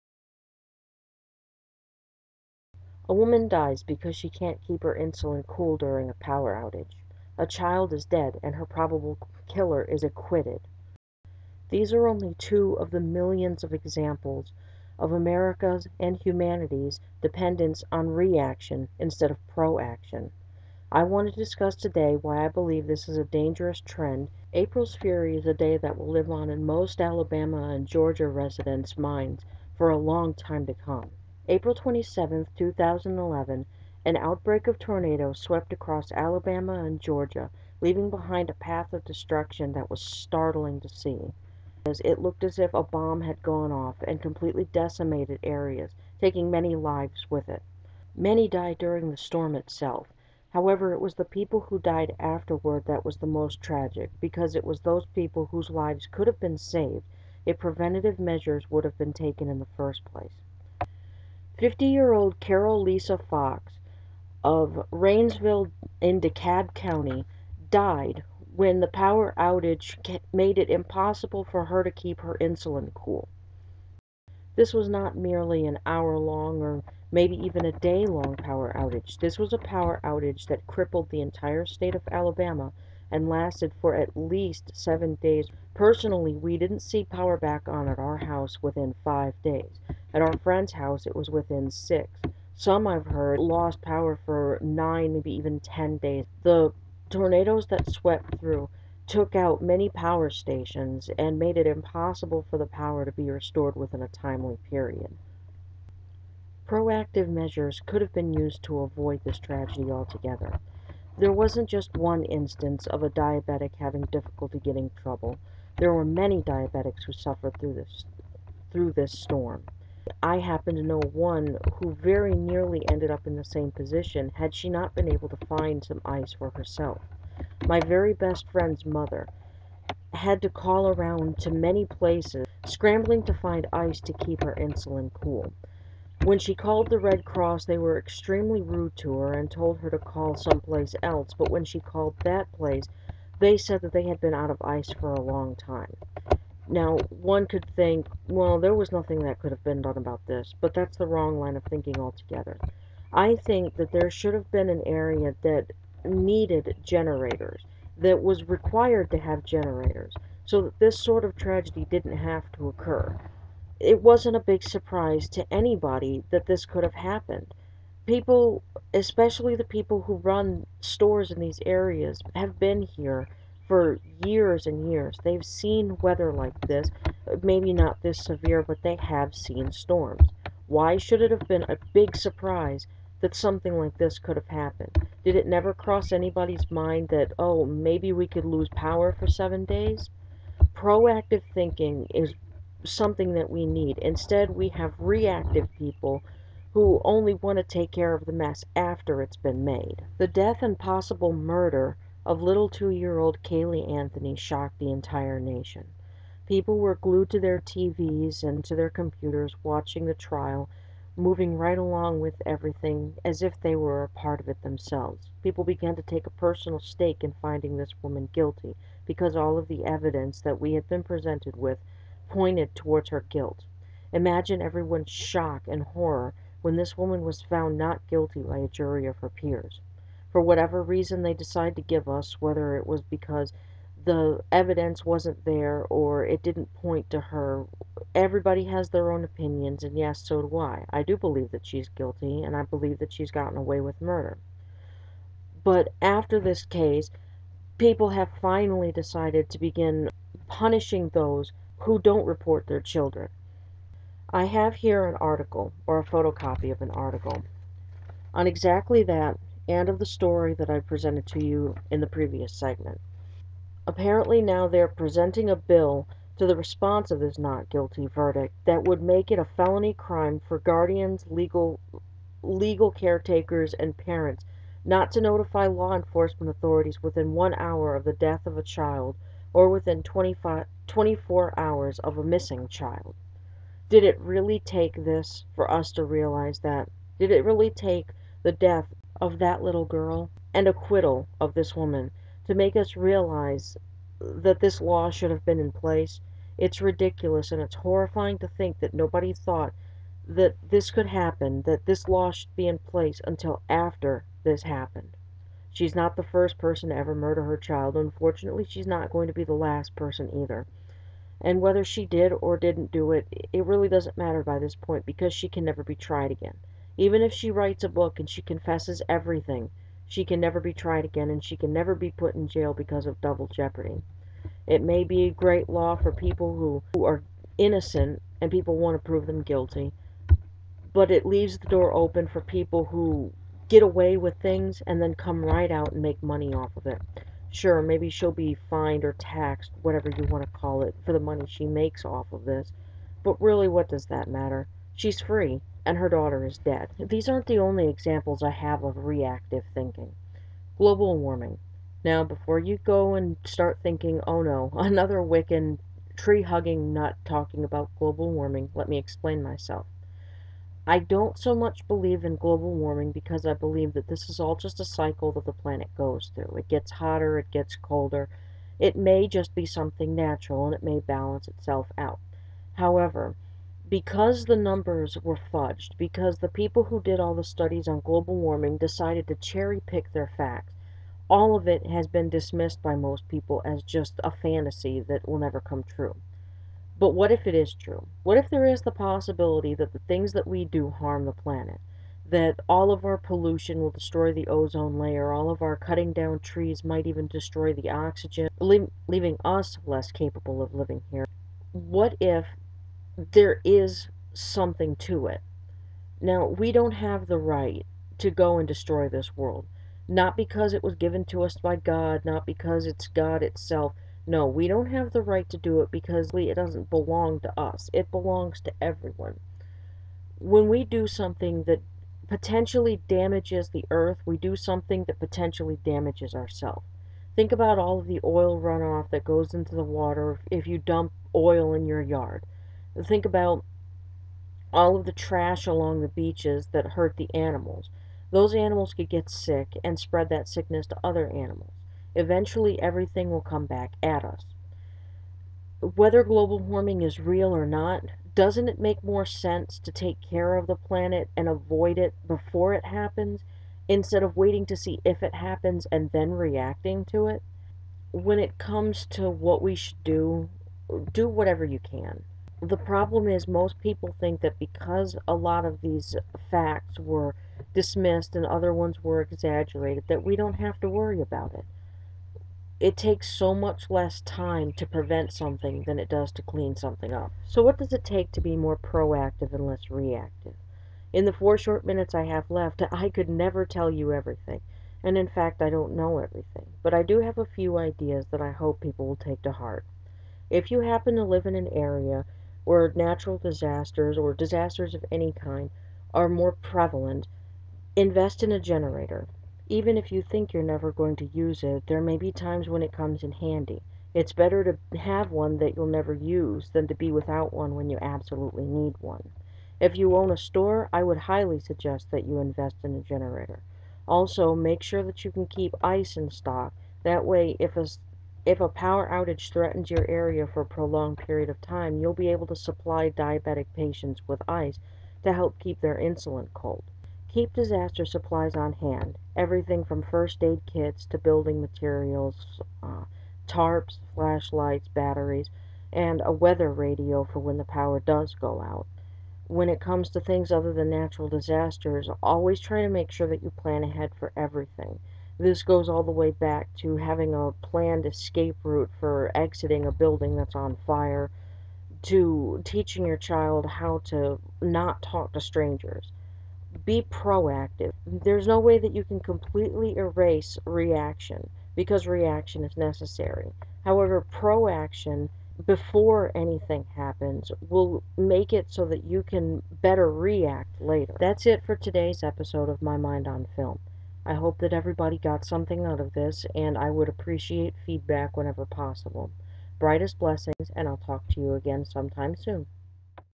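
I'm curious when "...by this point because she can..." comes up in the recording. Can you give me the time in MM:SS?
05:14.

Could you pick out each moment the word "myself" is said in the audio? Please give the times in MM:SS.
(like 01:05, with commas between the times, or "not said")
05:59.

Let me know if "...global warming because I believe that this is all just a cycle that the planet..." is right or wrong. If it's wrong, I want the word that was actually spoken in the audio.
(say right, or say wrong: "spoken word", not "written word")
right.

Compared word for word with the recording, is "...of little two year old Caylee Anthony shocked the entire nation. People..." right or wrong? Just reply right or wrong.
right.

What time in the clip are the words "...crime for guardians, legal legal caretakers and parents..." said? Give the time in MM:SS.
04:29.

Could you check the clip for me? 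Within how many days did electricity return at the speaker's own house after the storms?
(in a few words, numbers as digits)
5.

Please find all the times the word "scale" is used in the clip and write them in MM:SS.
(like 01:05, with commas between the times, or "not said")
not said.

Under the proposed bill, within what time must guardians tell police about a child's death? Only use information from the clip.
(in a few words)
1 hour.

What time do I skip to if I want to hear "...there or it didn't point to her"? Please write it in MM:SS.
03:55.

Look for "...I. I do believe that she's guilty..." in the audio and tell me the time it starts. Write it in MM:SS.
04:00.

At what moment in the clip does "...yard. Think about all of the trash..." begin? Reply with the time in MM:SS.
07:12.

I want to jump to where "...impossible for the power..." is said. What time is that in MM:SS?
01:41.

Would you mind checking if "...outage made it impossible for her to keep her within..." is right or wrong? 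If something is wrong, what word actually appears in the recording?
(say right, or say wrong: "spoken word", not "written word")
wrong: "insulin", not "within".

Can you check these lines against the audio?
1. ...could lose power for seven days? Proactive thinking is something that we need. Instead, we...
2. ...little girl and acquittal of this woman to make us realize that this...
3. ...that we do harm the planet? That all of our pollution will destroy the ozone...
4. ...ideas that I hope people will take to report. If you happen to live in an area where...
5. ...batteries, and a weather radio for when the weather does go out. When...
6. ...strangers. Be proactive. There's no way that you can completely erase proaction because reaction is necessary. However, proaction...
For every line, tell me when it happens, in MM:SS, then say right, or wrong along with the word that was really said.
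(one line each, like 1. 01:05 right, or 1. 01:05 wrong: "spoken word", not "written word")
1. 03:08 right
2. 04:49 right
3. 06:30 right
4. 08:07 wrong: "heart", not "report"
5. 08:54 wrong: "power", not "weather"
6. 09:15 wrong: "reaction", not "proaction".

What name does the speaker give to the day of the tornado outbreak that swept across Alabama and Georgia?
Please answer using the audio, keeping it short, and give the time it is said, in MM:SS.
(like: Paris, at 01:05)
April's Fury, at 00:24.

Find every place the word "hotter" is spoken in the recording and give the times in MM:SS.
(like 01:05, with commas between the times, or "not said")
06:06.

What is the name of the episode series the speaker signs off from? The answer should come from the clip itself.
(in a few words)
My Mind on Film.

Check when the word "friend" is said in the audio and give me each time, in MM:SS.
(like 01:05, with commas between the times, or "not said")
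01:30, 02:08.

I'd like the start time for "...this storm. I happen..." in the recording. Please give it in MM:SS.
01:58.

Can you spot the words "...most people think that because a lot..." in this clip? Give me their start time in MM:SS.
07:43.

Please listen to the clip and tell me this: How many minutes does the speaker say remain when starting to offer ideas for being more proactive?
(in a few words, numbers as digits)
4.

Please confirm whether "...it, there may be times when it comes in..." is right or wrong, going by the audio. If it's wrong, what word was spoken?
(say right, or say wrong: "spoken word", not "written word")
right.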